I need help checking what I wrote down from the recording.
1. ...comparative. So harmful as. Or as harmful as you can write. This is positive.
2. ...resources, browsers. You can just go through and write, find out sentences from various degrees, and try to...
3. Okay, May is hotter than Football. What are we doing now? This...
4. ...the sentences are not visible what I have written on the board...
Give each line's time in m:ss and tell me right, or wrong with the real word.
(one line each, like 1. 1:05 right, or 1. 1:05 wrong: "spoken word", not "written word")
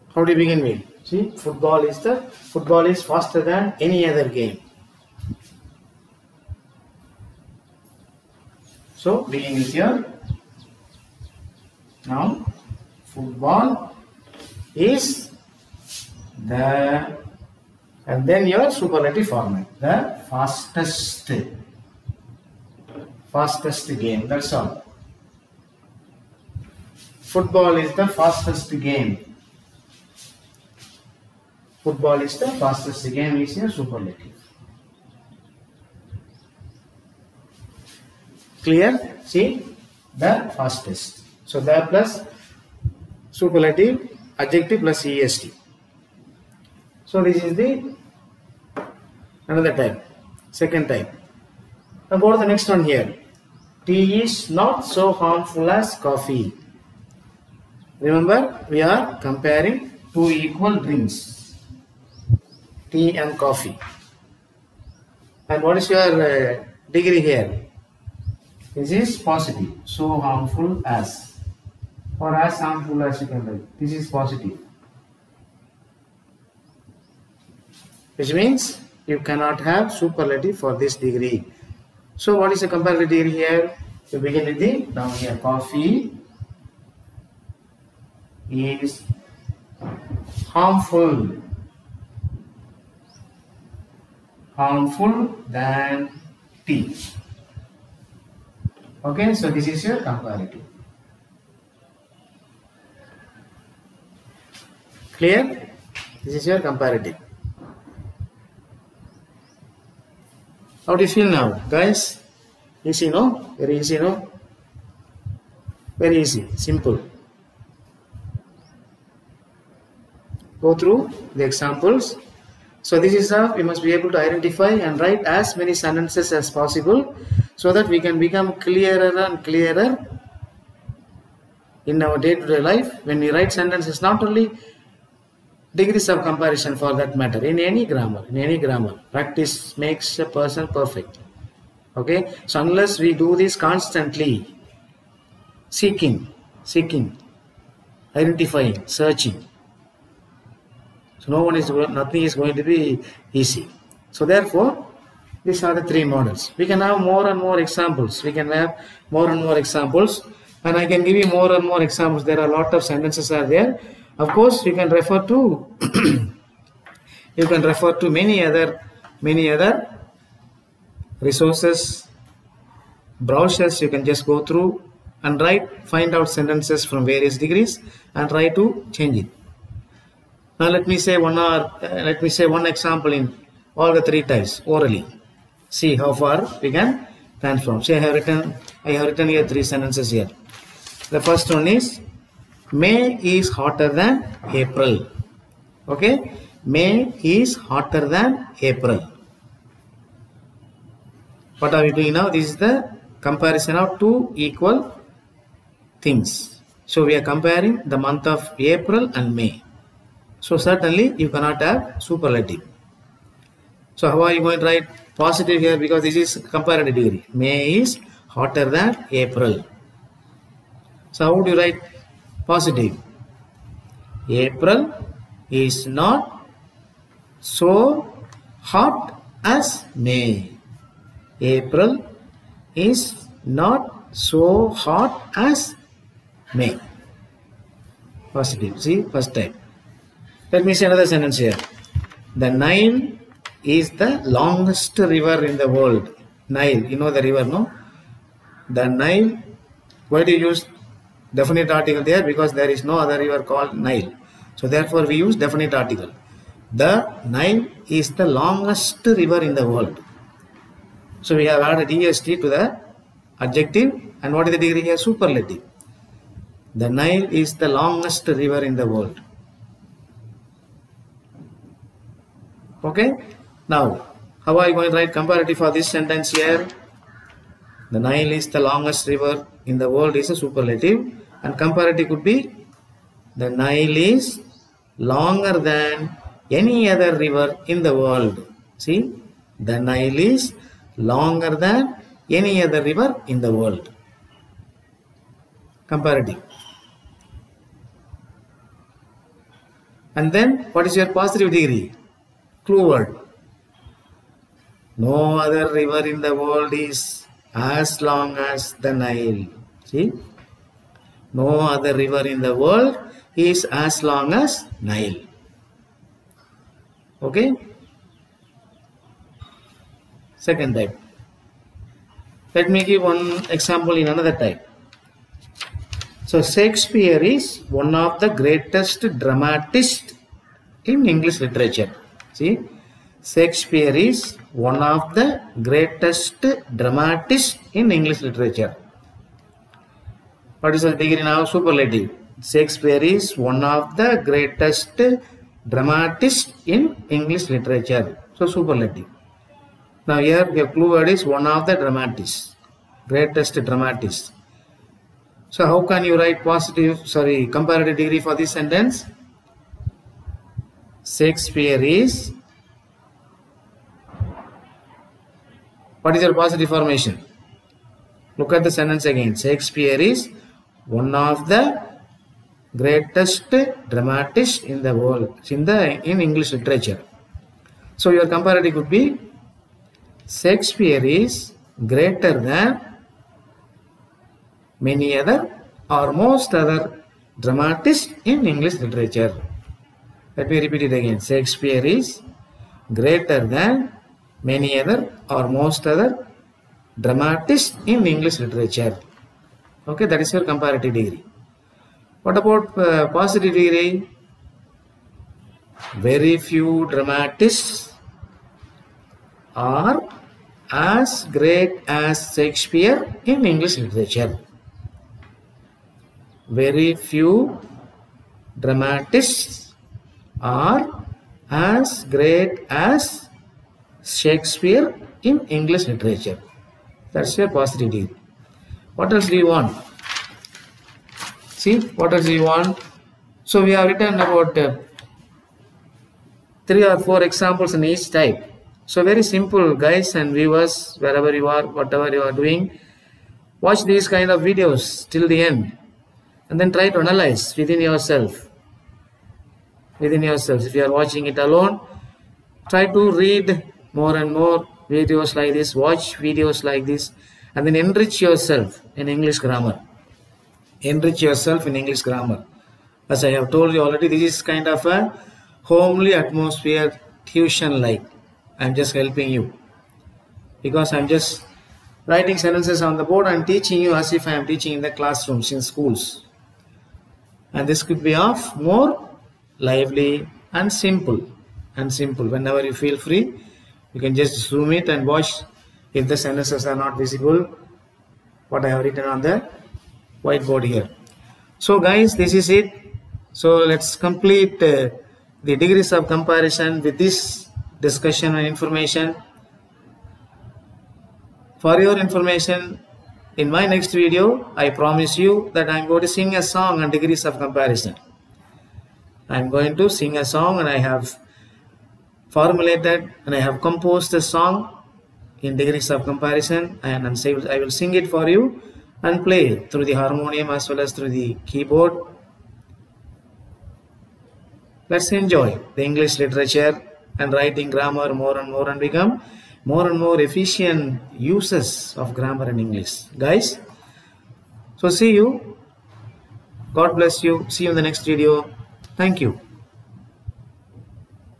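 1. 1:09 wrong: "positive", not "comparative"
2. 2:51 right
3. 3:15 wrong: "April", not "Football"
4. 8:06 wrong: "whiteboard", not "board".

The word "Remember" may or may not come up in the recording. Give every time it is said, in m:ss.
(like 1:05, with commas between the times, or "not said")
0:57.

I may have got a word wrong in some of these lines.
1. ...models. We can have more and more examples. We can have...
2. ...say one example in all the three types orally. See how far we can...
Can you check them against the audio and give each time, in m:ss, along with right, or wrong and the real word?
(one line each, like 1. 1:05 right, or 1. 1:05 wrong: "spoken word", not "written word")
1. 2:36 right
2. 3:02 right.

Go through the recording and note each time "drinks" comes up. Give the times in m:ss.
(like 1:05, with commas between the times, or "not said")
1:00.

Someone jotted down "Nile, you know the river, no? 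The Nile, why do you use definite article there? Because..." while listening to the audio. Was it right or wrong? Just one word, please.
right.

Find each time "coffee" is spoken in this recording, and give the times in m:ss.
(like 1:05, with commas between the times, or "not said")
0:55, 1:03, 1:25.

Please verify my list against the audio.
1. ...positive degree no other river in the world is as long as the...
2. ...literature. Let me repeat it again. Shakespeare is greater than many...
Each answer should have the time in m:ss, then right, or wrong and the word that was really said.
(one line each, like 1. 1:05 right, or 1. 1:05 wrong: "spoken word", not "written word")
1. 5:01 right
2. 6:28 right.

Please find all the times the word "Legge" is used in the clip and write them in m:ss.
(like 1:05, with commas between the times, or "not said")
not said.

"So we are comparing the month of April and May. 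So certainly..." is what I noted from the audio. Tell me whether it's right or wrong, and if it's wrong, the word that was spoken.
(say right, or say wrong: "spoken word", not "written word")
right.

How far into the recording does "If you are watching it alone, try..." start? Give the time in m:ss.
7:30.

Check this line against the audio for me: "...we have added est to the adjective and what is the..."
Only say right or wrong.
right.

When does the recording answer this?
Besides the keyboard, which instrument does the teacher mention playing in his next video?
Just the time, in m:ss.
8:39.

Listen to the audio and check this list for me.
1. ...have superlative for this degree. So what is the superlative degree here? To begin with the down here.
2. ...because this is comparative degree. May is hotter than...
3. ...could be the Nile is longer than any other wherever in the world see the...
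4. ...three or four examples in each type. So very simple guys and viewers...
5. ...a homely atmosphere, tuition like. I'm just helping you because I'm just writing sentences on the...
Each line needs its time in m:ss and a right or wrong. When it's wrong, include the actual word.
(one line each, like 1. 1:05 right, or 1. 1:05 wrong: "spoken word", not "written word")
1. 1:19 wrong: "comparative", not "superlative"
2. 3:35 right
3. 4:42 wrong: "river", not "wherever"
4. 7:16 right
5. 7:44 right.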